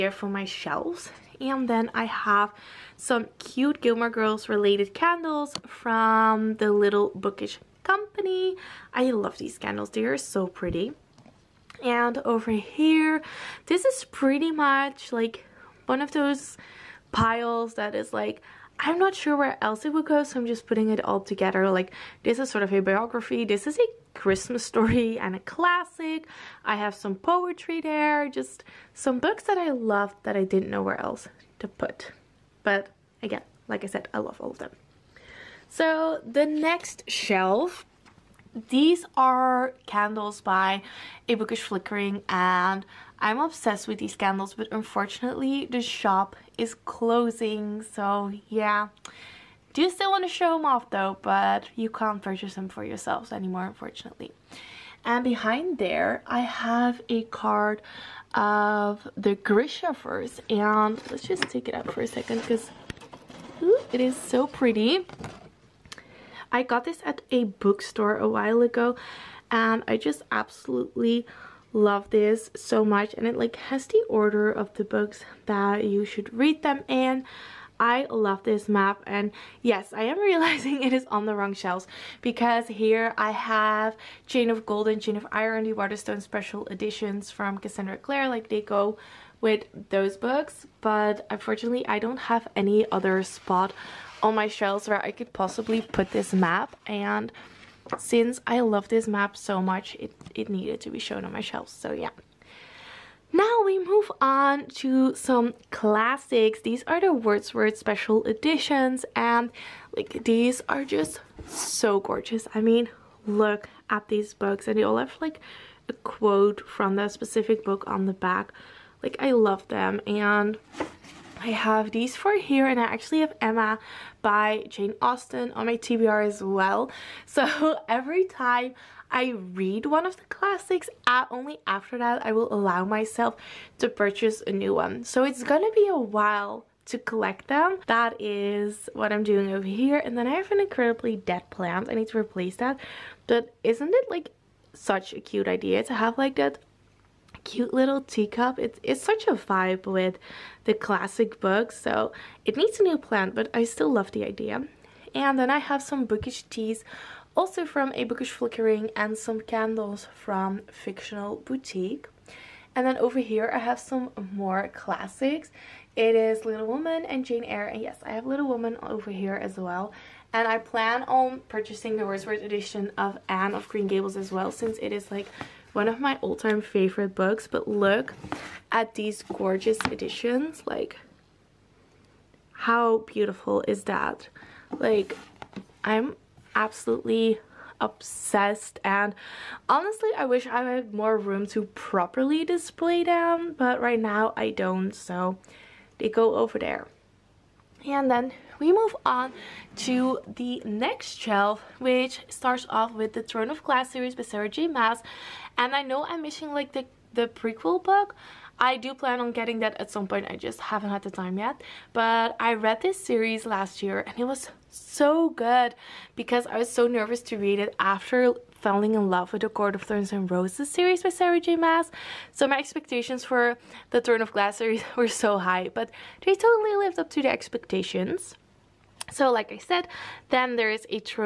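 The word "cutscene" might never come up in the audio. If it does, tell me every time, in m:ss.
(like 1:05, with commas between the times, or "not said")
not said.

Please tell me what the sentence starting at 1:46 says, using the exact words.
These are the Wordsworth special editions and like these are just so gorgeous.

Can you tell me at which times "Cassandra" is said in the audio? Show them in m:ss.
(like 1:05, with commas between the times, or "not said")
1:27.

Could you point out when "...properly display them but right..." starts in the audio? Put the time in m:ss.
3:11.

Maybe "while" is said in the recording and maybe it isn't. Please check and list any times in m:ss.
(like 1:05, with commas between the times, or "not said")
1:08, 2:15.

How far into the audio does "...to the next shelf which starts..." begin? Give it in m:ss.
3:19.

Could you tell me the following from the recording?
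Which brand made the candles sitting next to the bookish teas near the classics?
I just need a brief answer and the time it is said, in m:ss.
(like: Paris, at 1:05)
Fictional Boutique, at 2:40.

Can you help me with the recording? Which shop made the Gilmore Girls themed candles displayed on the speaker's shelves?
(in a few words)
Little Bookish Company.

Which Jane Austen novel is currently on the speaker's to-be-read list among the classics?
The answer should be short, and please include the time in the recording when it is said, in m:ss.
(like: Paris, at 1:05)
Emma, at 2:03.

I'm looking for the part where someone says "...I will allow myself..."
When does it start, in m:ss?
2:12.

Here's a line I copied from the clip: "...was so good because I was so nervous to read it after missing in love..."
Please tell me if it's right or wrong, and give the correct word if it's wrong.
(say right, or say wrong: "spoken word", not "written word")
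wrong: "falling", not "missing".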